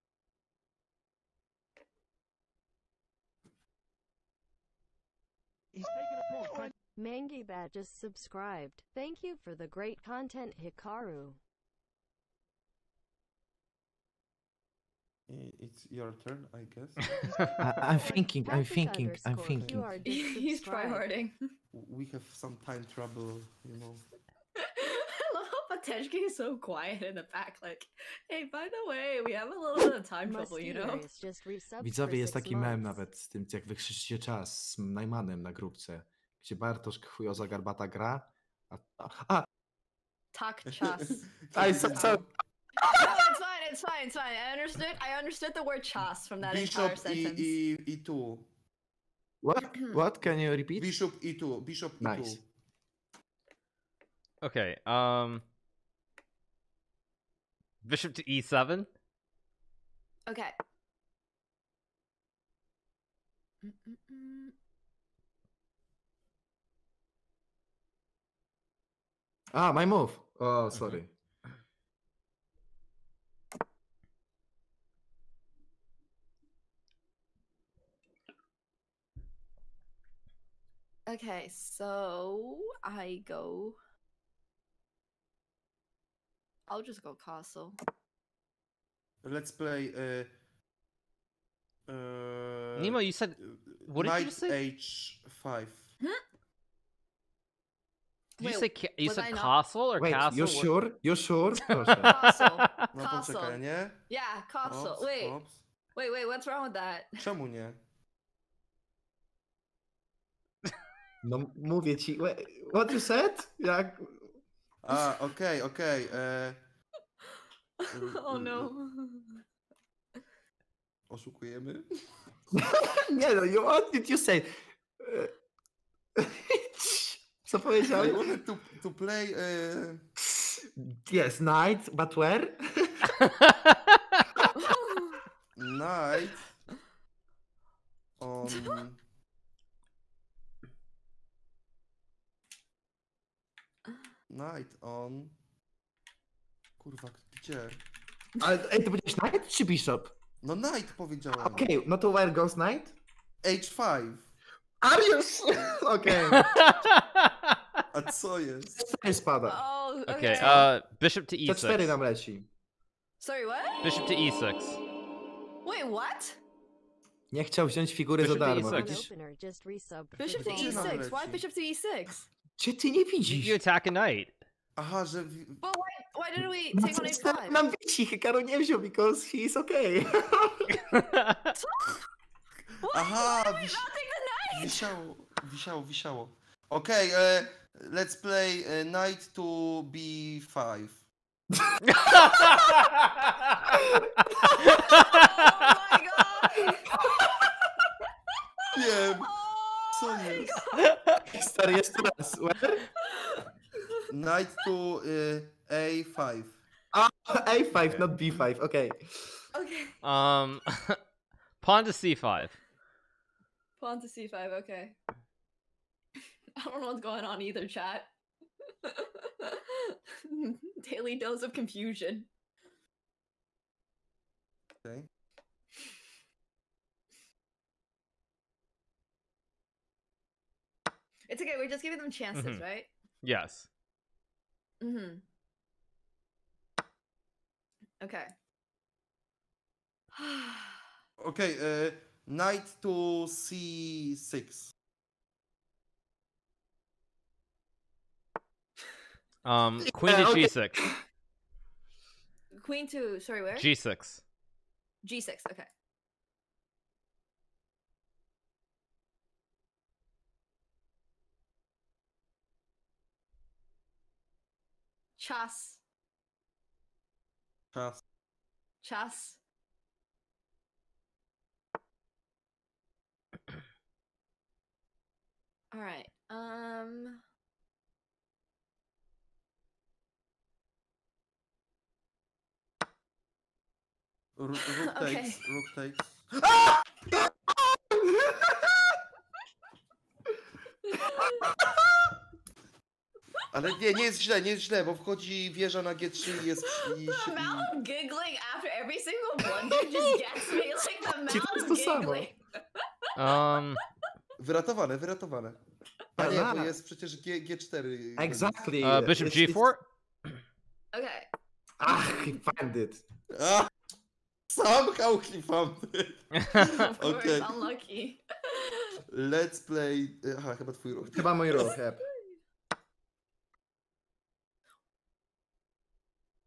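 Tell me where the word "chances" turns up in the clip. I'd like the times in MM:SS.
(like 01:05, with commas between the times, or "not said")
03:52.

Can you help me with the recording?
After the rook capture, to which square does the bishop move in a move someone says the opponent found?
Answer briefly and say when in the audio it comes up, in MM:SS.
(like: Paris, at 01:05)
G4, at 05:09.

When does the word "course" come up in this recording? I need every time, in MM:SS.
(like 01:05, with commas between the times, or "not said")
05:15.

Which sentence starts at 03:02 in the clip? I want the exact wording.
Aha, uh-huh, why wisiało, wisiało, wisiało.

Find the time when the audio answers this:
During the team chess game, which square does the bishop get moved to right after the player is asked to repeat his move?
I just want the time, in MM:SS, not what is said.
00:50.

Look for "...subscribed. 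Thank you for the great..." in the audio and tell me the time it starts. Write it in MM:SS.
00:07.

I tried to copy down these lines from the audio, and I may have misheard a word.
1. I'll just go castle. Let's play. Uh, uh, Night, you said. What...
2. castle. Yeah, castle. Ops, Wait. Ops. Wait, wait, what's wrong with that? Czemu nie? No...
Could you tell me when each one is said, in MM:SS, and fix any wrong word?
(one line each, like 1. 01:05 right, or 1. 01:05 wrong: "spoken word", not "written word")
1. 01:26 wrong: "Nemo", not "Night"
2. 01:42 right.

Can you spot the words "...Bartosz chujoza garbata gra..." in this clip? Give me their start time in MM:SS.
00:36.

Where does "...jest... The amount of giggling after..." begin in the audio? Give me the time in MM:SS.
04:56.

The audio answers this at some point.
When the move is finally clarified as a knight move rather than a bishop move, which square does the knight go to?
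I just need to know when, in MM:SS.
02:33.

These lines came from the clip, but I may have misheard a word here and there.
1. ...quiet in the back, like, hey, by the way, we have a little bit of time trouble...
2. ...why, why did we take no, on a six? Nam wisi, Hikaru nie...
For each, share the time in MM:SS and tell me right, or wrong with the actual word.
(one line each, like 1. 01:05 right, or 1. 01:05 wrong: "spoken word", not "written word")
1. 00:26 right
2. 02:55 wrong: "five", not "six".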